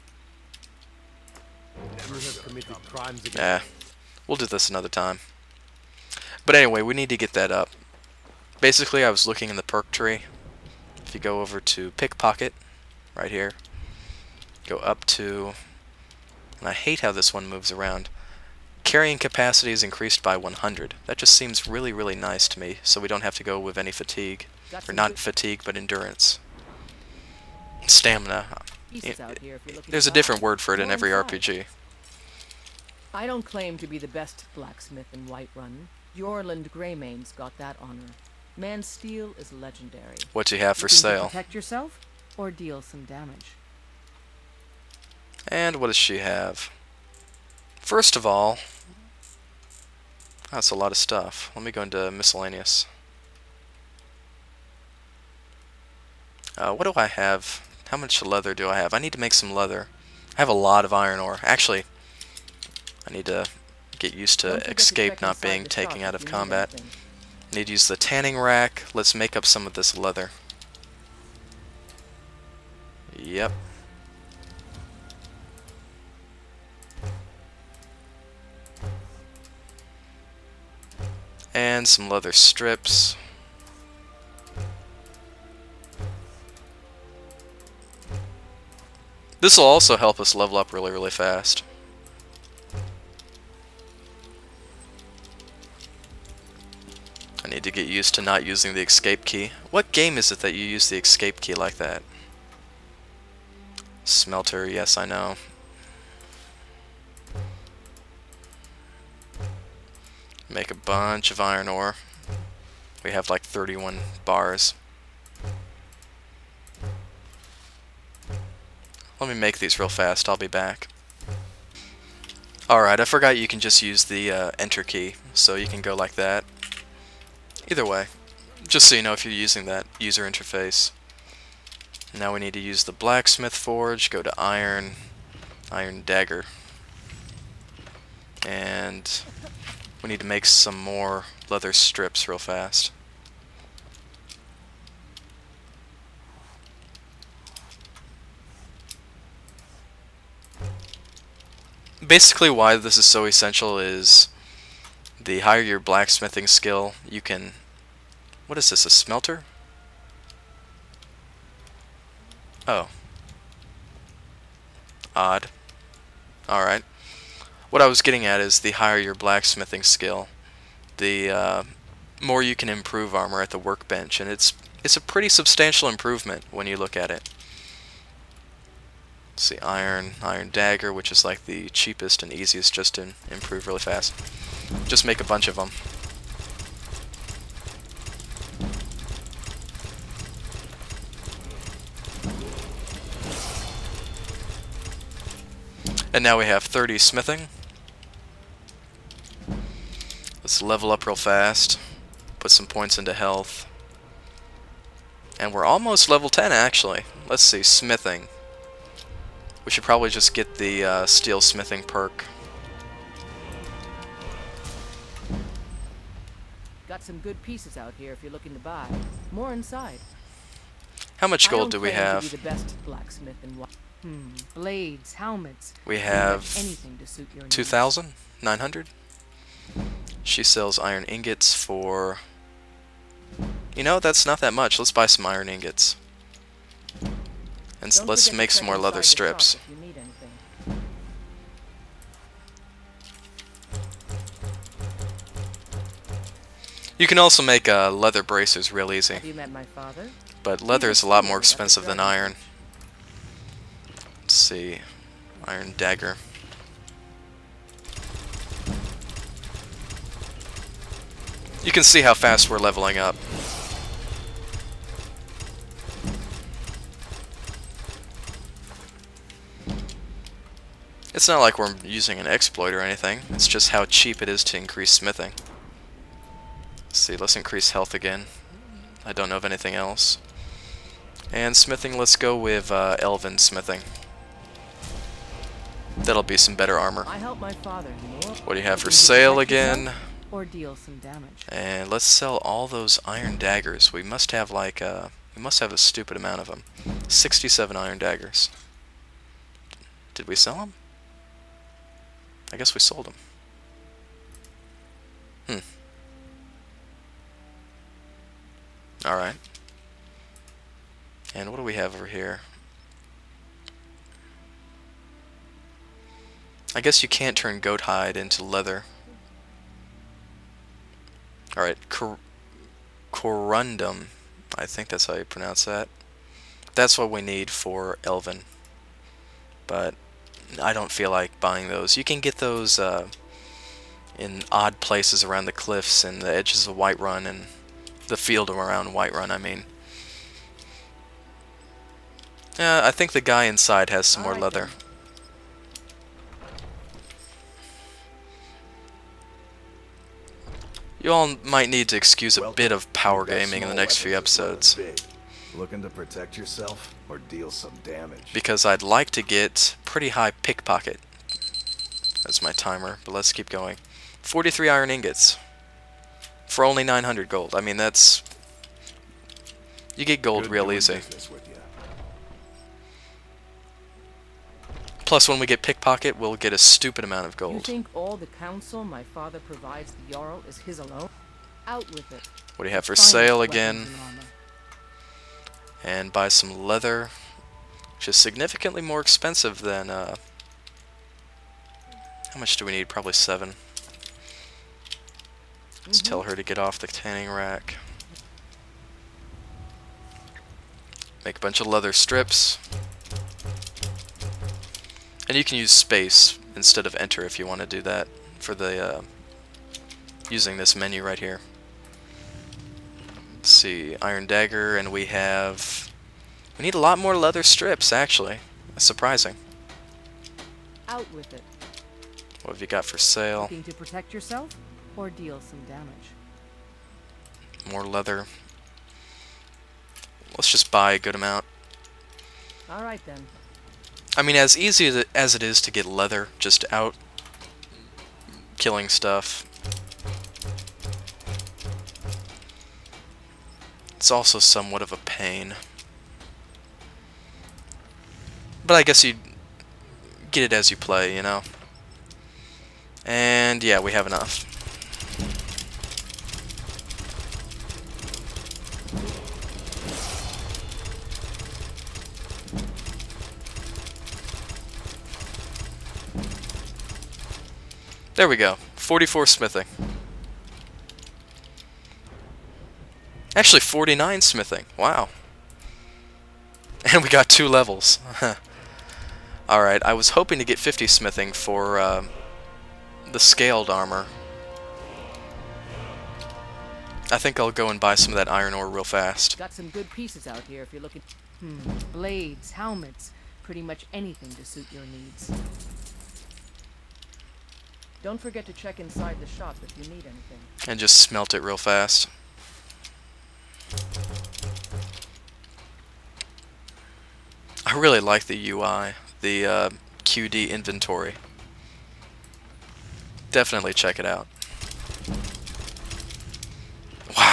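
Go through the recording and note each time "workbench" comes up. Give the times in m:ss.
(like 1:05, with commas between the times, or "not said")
2:53.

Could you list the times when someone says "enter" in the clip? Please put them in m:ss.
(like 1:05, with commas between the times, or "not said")
2:04, 6:46.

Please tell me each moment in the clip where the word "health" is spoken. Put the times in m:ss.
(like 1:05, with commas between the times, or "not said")
3:23, 4:37.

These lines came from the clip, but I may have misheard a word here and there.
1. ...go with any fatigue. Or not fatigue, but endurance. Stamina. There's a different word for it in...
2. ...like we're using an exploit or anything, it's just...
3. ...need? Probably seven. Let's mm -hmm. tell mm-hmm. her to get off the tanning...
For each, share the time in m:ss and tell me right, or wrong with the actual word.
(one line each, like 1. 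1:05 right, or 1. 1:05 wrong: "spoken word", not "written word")
1. 0:23 right
2. 4:31 right
3. 6:32 right.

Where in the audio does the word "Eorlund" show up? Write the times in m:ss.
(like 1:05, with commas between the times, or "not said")
0:36.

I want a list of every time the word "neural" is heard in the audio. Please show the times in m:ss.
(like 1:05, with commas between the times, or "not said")
not said.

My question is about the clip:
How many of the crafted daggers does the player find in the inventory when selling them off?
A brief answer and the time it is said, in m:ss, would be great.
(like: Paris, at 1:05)
67, at 4:57.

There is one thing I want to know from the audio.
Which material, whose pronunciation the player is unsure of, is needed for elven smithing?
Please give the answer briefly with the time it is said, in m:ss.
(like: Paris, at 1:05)
Corundum, at 5:23.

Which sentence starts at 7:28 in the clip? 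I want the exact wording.
But I guess you get it as you play, you know?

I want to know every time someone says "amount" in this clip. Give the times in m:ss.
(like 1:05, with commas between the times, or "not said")
4:56, 6:17, 7:11.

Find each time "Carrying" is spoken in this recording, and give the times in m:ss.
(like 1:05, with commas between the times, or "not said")
0:18.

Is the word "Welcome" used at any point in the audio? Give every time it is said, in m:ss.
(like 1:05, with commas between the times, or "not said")
5:52.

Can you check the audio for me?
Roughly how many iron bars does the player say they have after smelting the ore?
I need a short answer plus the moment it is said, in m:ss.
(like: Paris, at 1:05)
31, at 1:53.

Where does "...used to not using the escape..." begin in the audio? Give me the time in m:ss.
1:37.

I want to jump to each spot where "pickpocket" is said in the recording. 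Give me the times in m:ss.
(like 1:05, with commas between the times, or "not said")
0:11, 6:00, 6:15.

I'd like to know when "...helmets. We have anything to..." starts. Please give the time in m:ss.
3:45.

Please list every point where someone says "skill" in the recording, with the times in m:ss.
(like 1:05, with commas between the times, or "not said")
2:36, 2:49.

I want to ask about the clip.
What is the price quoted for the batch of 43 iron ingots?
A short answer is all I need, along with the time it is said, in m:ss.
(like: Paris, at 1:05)
900 gold, at 6:06.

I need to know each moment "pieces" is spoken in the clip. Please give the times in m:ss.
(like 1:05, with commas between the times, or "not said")
3:37, 8:09.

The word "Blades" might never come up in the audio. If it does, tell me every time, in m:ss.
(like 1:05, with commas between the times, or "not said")
3:44, 8:11.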